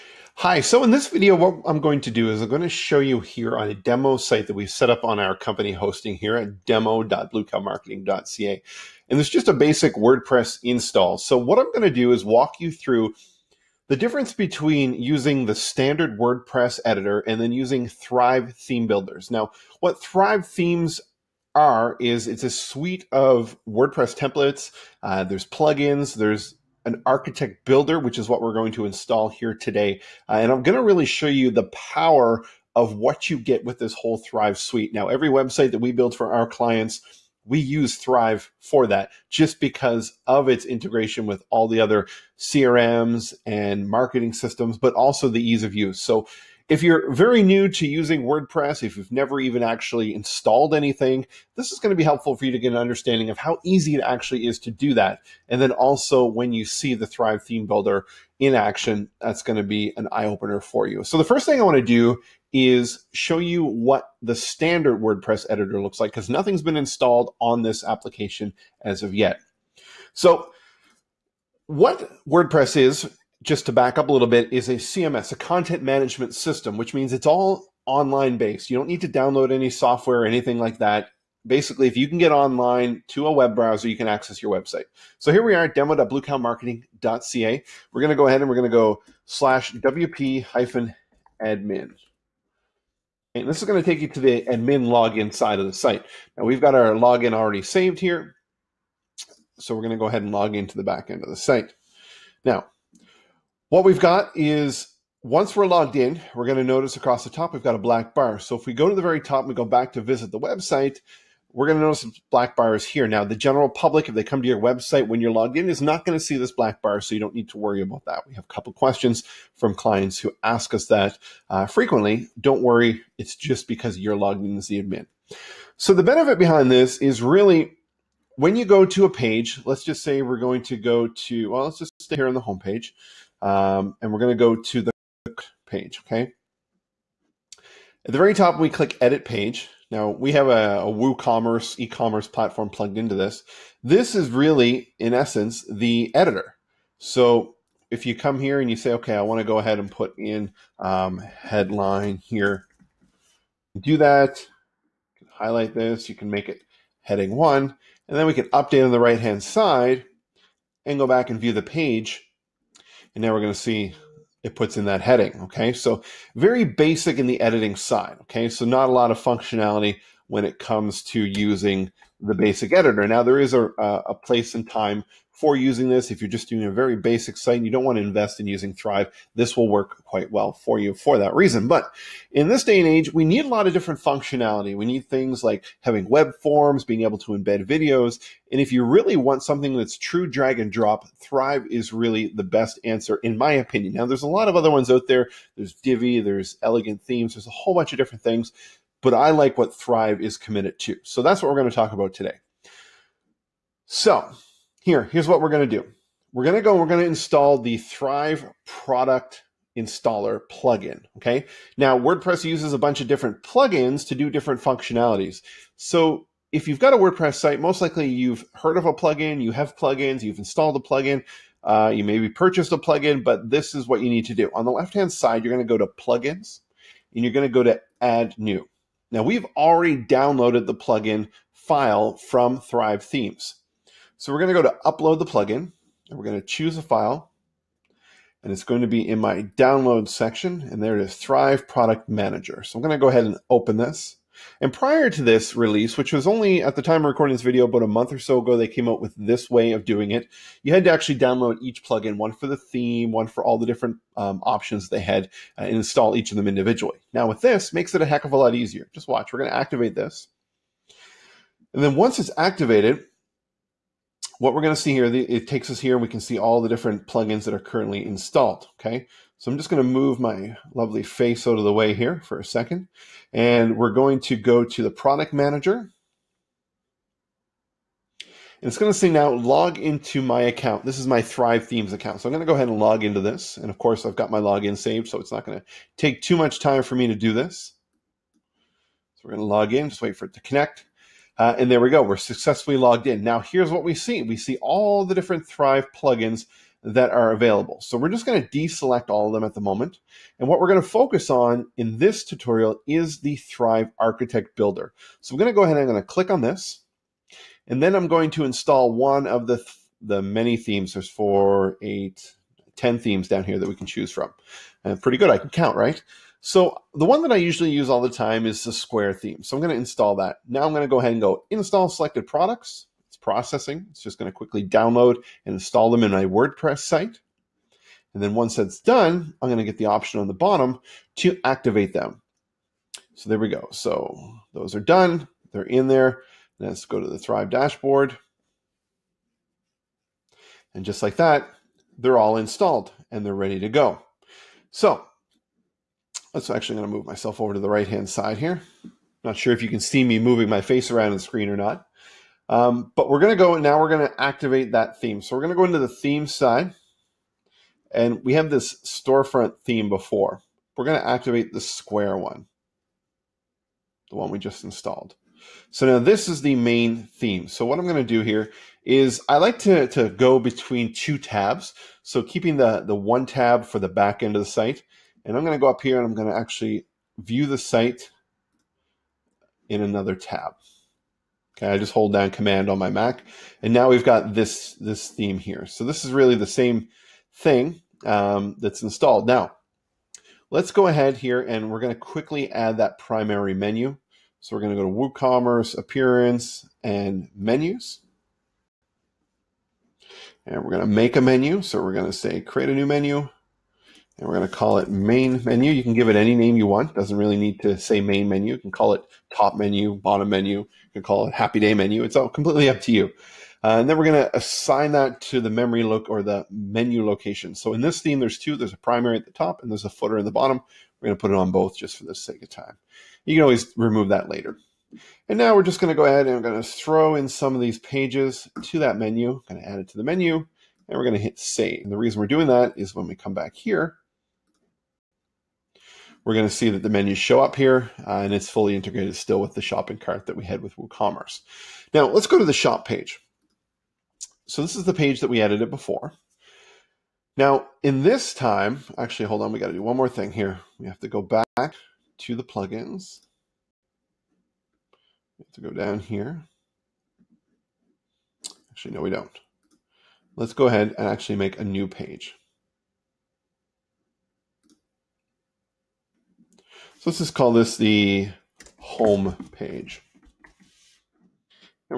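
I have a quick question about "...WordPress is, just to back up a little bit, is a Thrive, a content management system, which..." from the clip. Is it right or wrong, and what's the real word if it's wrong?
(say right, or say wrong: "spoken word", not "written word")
wrong: "CMS", not "Thrive".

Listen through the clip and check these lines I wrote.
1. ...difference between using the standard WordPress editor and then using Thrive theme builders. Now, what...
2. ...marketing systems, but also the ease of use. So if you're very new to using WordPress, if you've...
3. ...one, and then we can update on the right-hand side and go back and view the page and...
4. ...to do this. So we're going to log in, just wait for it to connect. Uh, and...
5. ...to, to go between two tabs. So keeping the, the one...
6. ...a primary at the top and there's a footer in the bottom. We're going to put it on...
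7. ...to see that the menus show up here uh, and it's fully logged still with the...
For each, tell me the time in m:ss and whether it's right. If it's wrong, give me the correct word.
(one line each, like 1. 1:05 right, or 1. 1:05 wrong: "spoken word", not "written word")
1. 0:13 right
2. 0:43 right
3. 2:37 right
4. 4:47 right
5. 6:09 right
6. 6:58 right
7. 7:16 wrong: "integrated", not "logged".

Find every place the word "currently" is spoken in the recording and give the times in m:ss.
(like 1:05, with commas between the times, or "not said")
4:27.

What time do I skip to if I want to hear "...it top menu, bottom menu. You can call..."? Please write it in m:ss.
6:48.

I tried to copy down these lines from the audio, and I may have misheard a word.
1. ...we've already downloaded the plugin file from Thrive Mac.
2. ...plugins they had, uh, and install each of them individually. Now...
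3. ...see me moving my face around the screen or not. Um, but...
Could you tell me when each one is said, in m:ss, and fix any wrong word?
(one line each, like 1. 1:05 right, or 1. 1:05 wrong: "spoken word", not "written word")
1. 3:49 wrong: "Themes", not "Mac"
2. 4:14 wrong: "options", not "plugins"
3. 5:49 right.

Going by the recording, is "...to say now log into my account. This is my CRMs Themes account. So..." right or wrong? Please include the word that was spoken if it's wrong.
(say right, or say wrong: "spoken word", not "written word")
wrong: "Thrive", not "CRMs".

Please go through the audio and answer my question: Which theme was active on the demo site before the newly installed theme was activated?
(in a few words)
Storefront.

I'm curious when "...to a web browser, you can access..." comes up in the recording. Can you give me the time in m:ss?
1:23.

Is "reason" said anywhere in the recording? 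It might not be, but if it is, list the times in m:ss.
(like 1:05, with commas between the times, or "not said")
3:01, 7:11.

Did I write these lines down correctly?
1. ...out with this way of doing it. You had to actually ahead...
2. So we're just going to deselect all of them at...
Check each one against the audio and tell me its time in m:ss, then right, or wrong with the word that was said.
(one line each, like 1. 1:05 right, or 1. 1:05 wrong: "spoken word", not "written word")
1. 4:08 wrong: "download", not "ahead"
2. 4:57 right.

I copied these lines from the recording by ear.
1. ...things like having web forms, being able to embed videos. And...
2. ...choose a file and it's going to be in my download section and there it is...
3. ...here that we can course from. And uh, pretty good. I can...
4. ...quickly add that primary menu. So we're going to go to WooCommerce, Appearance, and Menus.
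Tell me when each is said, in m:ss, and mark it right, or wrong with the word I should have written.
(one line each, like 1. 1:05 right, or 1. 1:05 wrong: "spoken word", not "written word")
1. 3:05 right
2. 3:56 right
3. 5:13 wrong: "choose", not "course"
4. 6:32 right.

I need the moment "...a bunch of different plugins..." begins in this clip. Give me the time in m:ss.
3:32.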